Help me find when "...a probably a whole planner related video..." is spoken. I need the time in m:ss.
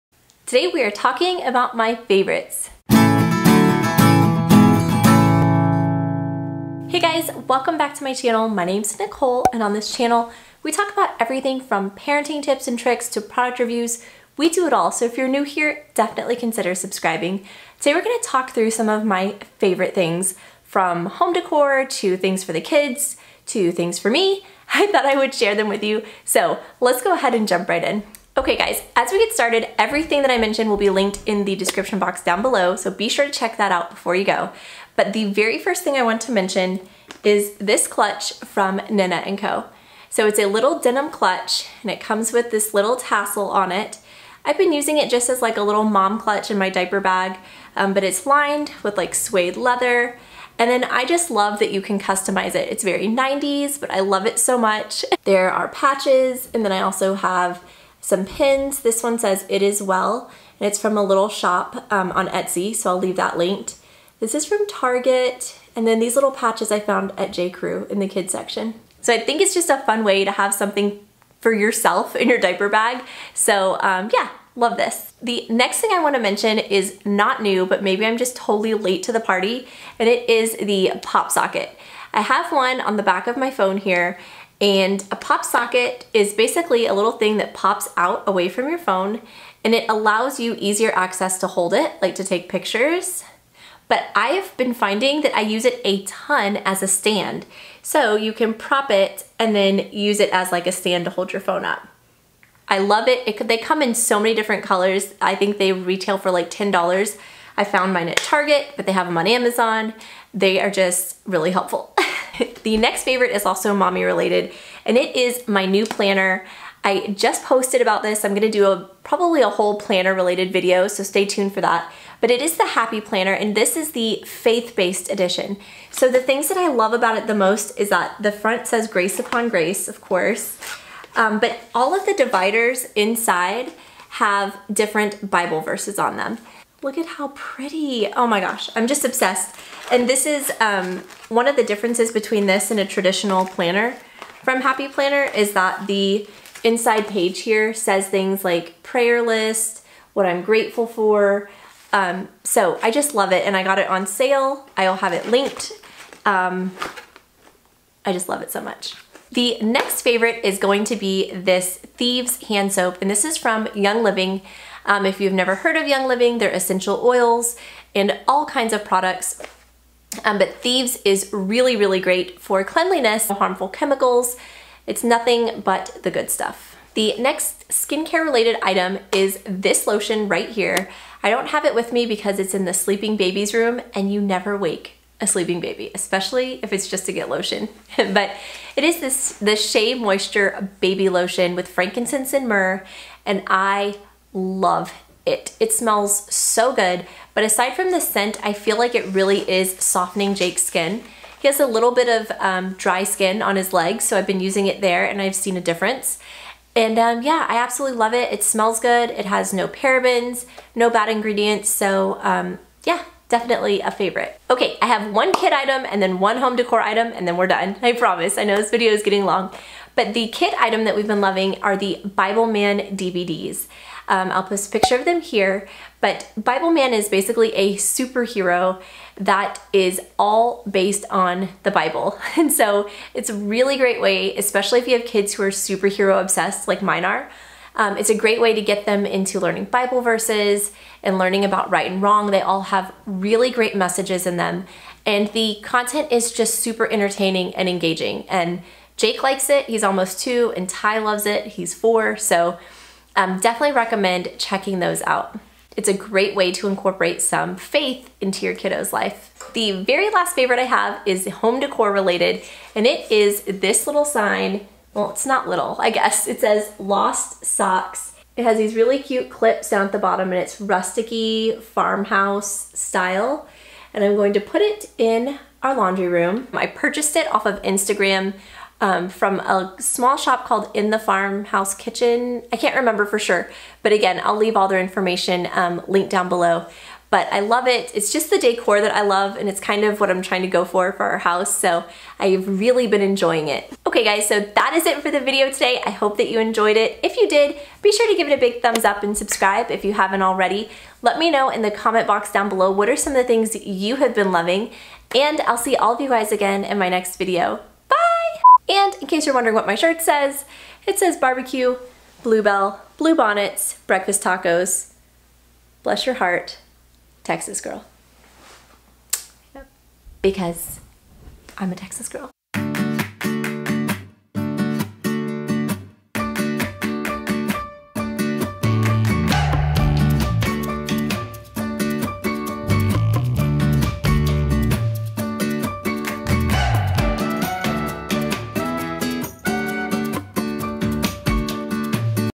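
1:58.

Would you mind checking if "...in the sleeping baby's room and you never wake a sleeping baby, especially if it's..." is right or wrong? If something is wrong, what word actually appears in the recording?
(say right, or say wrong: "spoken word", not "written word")
right.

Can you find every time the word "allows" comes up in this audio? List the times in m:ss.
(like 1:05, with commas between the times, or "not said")
1:29.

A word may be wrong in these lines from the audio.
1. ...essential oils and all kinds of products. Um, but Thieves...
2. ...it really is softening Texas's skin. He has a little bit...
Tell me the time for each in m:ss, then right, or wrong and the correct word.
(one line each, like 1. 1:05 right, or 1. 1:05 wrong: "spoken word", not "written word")
1. 2:46 right
2. 3:18 wrong: "Jake", not "Texas".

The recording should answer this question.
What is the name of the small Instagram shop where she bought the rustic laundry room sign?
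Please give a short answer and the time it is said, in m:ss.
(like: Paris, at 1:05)
In the Farmhouse Kitchen, at 4:40.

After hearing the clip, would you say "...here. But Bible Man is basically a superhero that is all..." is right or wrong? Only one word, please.
right.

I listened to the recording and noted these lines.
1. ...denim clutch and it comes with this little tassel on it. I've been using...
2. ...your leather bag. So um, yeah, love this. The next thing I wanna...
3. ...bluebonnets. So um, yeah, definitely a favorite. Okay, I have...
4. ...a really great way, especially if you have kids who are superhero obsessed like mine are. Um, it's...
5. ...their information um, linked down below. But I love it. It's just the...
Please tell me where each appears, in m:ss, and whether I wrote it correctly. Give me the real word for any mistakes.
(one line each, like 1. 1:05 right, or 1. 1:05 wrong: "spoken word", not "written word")
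1. 0:40 right
2. 1:12 wrong: "diaper", not "leather"
3. 3:31 wrong: "ingredients", not "bluebonnets"
4. 3:53 right
5. 4:44 right.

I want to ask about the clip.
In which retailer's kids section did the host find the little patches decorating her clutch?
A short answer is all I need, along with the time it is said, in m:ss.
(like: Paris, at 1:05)
J. Crew, at 1:07.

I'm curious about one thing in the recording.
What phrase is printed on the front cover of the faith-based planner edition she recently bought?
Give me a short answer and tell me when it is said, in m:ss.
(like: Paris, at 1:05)
grace upon grace, at 2:08.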